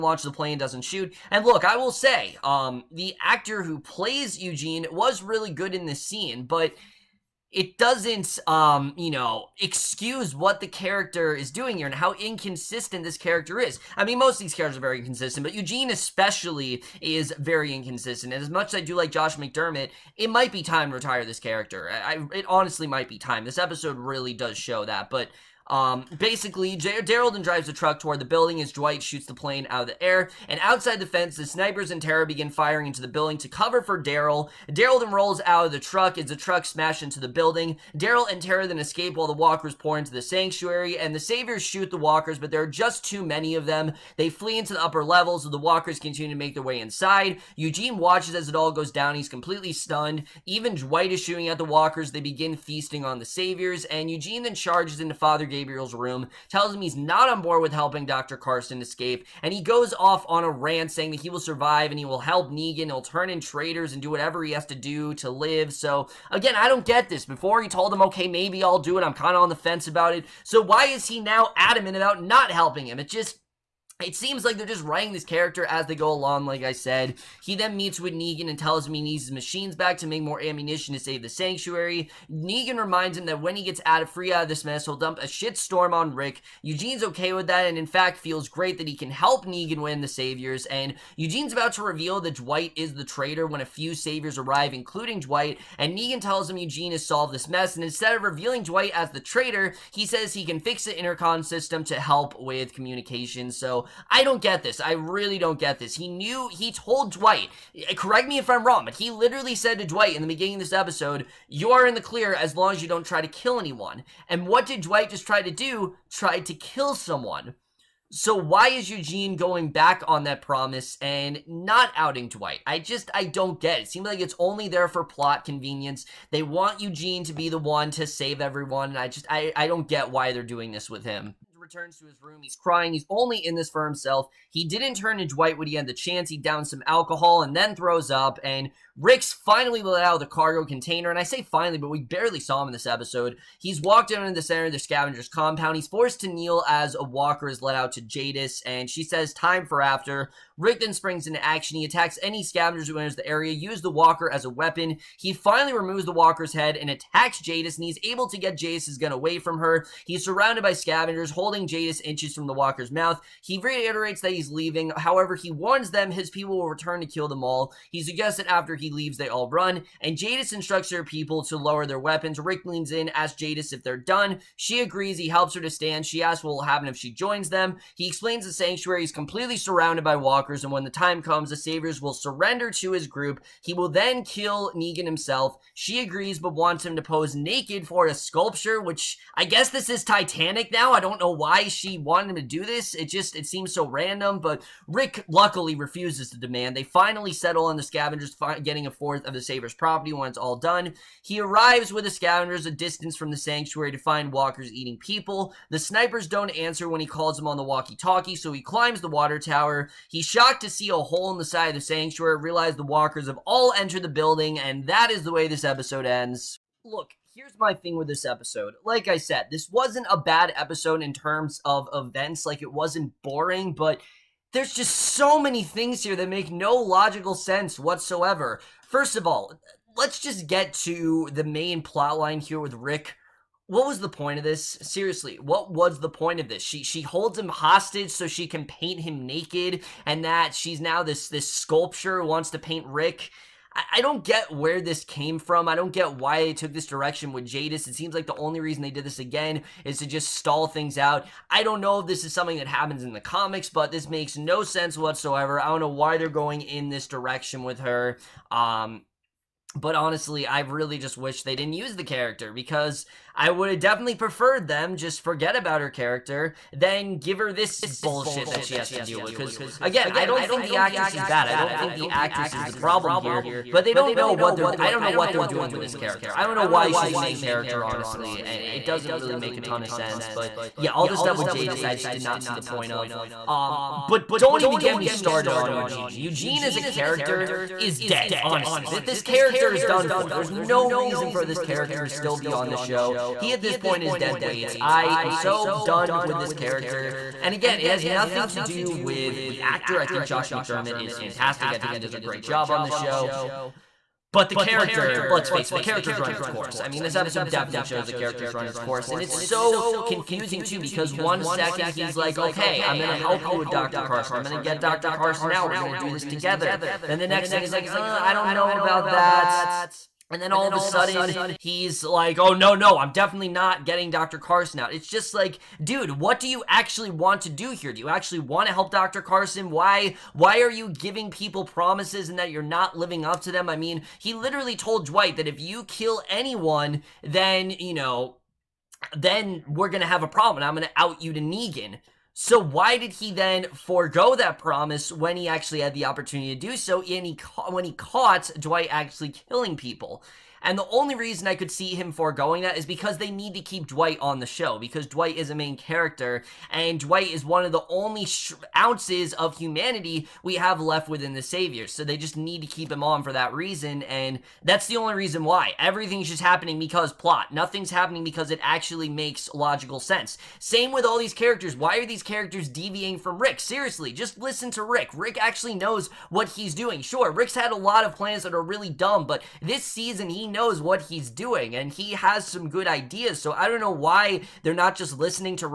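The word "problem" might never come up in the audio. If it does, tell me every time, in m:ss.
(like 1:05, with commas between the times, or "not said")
4:32, 5:40.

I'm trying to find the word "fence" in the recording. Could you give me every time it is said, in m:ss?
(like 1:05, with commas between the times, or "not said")
0:31, 1:09.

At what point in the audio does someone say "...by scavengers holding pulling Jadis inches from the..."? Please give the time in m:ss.
2:40.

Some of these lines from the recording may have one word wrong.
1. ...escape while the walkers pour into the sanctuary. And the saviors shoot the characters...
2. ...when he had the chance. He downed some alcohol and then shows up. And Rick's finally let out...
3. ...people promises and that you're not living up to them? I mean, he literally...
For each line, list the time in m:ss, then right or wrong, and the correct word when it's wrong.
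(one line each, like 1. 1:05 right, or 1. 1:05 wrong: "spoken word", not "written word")
1. 0:38 wrong: "walkers", not "characters"
2. 2:15 wrong: "throws", not "shows"
3. 5:31 right.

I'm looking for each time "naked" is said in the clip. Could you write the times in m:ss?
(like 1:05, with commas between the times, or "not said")
3:07, 3:59.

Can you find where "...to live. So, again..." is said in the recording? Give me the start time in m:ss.
1:05.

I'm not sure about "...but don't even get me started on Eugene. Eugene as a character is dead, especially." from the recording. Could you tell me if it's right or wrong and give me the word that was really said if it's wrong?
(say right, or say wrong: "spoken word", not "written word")
wrong: "honestly", not "especially".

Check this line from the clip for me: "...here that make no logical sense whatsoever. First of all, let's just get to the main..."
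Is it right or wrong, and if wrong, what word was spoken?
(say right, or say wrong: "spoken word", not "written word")
right.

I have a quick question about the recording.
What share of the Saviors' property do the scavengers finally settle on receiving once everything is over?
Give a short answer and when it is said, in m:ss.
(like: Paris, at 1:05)
a fourth, at 3:18.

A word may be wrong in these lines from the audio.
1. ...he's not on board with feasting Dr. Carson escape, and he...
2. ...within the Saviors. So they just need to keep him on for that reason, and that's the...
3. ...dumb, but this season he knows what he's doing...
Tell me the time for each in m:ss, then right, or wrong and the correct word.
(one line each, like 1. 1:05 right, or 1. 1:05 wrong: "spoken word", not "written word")
1. 0:56 wrong: "helping", not "feasting"
2. 6:01 right
3. 6:18 right.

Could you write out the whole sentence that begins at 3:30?
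He's shocked to see a hole in the side of the sanctuary.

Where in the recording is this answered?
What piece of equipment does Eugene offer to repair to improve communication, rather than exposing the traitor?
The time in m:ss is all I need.
1:40.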